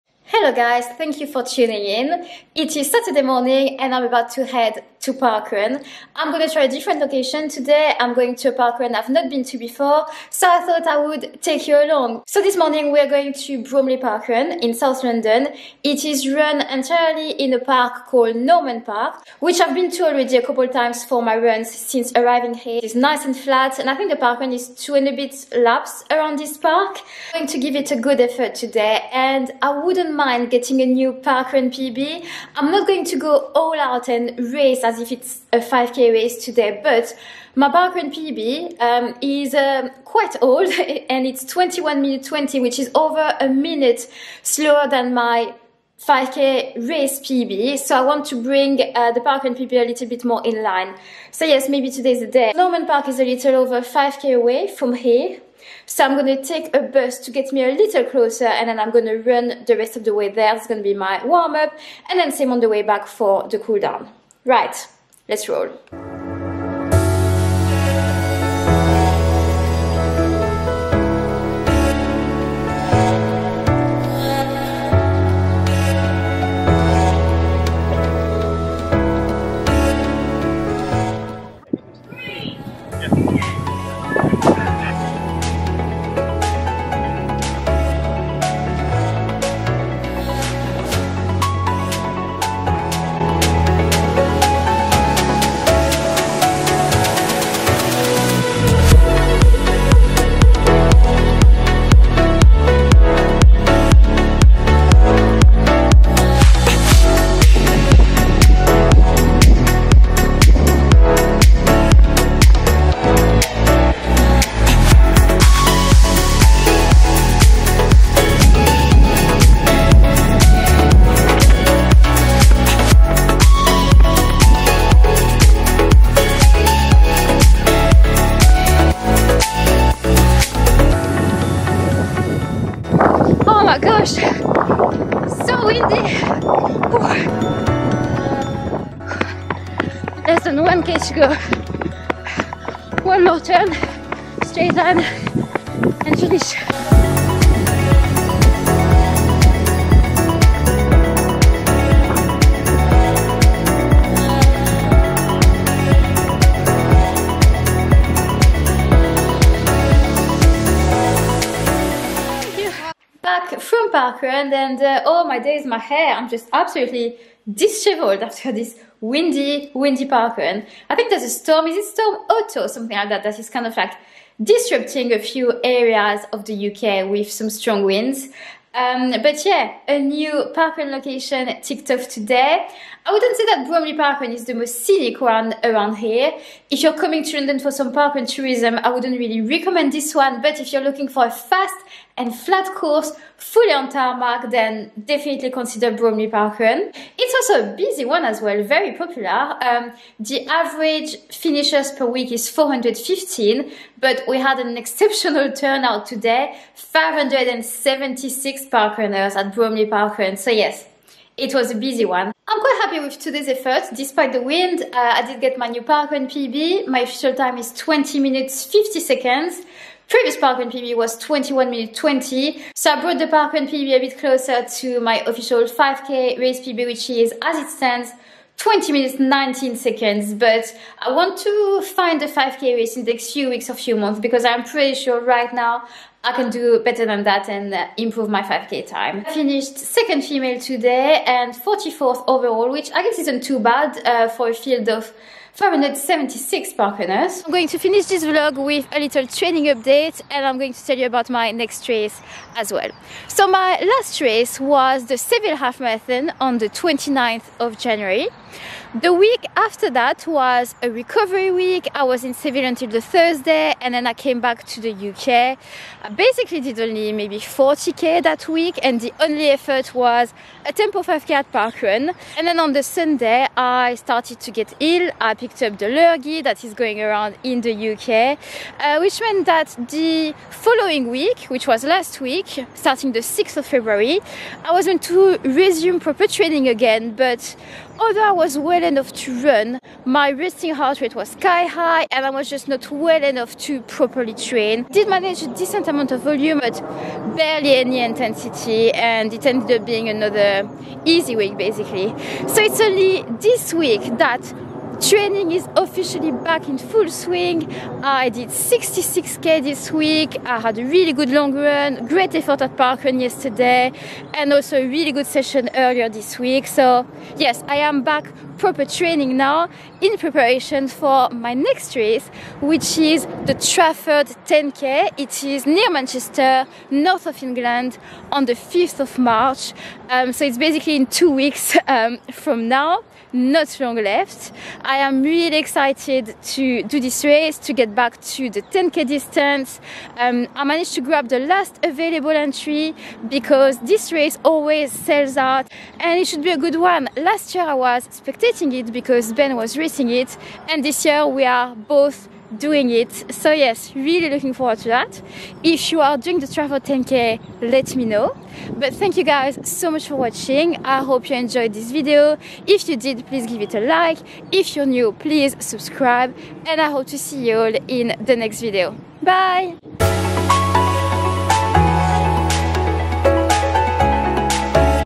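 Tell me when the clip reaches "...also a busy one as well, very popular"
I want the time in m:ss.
3:17.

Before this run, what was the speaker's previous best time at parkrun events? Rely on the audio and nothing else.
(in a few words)
21 minutes 20.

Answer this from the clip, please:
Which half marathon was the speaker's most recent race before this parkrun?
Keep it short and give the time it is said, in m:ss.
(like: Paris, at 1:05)
Seville Half Marathon, at 4:15.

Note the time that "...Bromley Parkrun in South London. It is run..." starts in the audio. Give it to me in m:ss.
0:13.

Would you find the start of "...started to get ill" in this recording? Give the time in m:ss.
4:33.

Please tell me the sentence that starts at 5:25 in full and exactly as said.
It is near Manchester, north of England, on the 5th of March.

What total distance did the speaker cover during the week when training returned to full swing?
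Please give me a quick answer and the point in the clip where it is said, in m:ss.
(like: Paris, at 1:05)
66k, at 5:08.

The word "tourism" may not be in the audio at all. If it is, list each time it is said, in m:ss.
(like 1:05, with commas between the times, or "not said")
3:08.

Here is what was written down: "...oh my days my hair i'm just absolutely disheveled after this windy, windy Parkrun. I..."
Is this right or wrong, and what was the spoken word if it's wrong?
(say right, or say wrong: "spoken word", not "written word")
right.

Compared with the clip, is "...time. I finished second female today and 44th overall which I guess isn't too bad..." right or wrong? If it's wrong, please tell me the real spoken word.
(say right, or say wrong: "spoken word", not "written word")
right.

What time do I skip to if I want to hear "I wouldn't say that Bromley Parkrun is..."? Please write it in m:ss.
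3:03.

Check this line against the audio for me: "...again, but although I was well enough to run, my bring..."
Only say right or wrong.
wrong.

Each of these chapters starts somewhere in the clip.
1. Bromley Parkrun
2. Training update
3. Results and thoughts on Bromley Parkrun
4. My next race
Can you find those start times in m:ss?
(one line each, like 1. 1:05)
1. 1:05
2. 4:07
3. 2:43
4. 5:19.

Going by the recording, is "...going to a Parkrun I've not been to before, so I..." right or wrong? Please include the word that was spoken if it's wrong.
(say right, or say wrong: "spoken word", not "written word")
right.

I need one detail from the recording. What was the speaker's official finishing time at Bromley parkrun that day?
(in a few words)
20 minutes 50 seconds.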